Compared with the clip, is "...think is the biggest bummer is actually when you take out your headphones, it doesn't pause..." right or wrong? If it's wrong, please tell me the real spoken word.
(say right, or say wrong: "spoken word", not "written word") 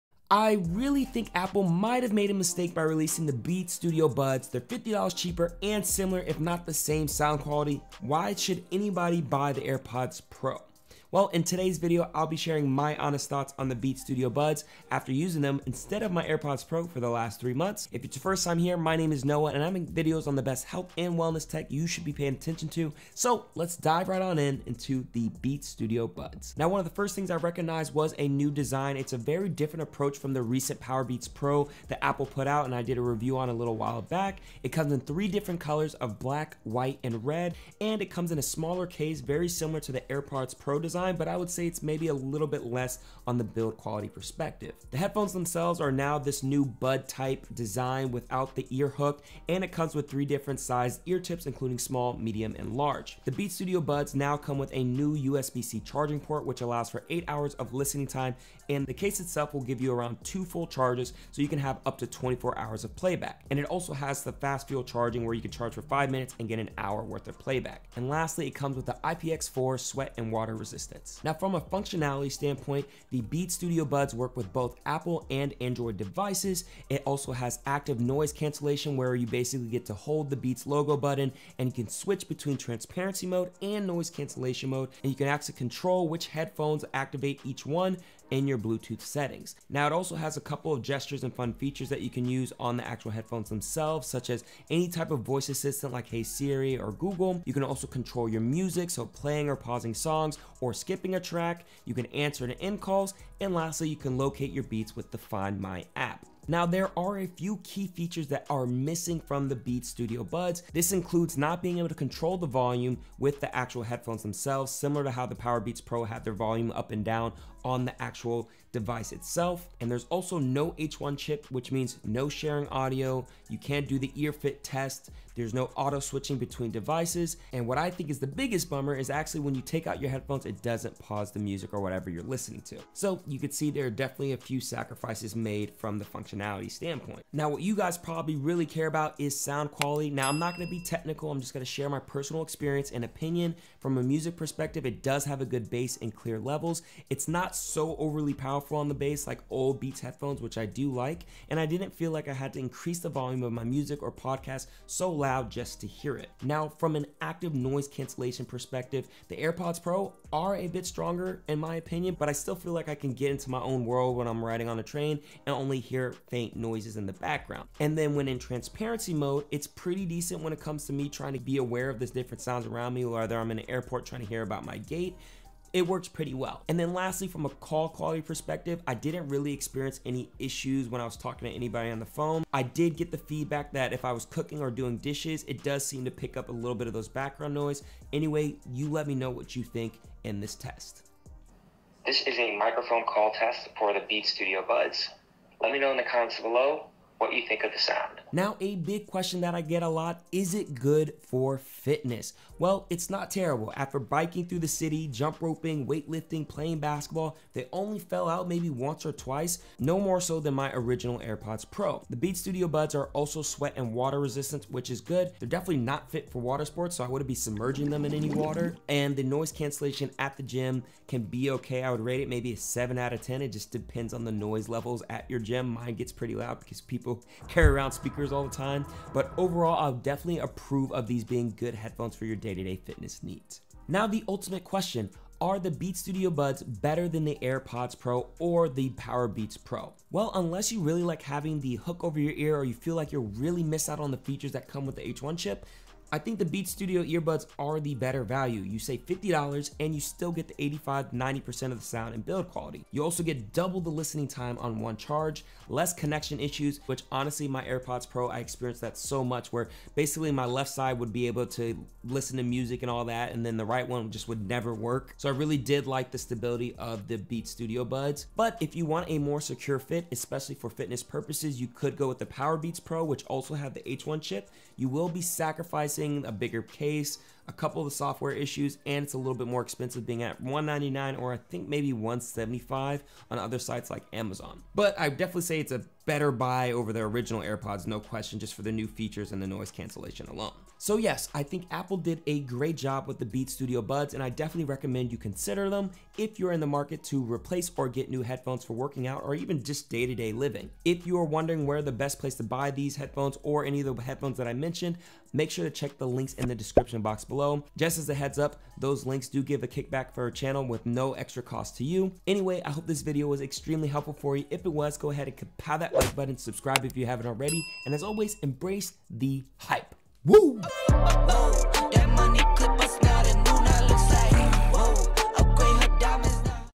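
right.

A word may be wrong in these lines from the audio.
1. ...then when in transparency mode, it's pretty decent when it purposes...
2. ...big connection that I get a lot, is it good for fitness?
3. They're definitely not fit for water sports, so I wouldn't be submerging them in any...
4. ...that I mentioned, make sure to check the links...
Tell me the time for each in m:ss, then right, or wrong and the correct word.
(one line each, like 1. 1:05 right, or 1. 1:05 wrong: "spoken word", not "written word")
1. 2:47 wrong: "comes", not "purposes"
2. 3:18 wrong: "question", not "connection"
3. 3:35 right
4. 5:04 right.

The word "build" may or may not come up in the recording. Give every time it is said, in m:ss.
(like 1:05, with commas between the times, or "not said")
0:43, 4:12.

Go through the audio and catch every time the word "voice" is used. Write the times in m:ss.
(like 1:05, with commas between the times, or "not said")
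1:35.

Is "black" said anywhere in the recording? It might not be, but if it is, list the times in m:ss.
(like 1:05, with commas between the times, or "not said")
0:36.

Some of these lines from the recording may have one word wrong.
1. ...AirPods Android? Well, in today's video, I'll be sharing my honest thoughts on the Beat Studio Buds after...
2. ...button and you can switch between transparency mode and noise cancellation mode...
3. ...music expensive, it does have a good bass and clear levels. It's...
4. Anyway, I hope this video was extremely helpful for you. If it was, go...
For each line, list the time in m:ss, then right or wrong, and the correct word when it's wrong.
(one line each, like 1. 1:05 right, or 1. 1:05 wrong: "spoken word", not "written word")
1. 0:09 wrong: "Pro", not "Android"
2. 1:20 right
3. 2:24 wrong: "perspective", not "expensive"
4. 5:12 right.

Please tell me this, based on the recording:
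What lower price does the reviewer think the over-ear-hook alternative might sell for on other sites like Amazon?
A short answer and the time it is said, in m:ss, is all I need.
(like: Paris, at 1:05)
$175, at 4:41.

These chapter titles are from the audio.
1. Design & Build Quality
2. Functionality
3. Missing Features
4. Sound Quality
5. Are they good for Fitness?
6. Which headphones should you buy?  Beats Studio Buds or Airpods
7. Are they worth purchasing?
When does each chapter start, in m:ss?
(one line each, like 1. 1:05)
1. 0:28
2. 1:11
3. 1:46
4. 2:18
5. 3:20
6. 3:57
7. 4:50.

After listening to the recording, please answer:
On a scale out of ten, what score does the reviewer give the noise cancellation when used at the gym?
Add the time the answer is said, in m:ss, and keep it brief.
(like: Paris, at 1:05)
7, at 3:42.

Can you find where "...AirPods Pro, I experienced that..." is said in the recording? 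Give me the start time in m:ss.
4:17.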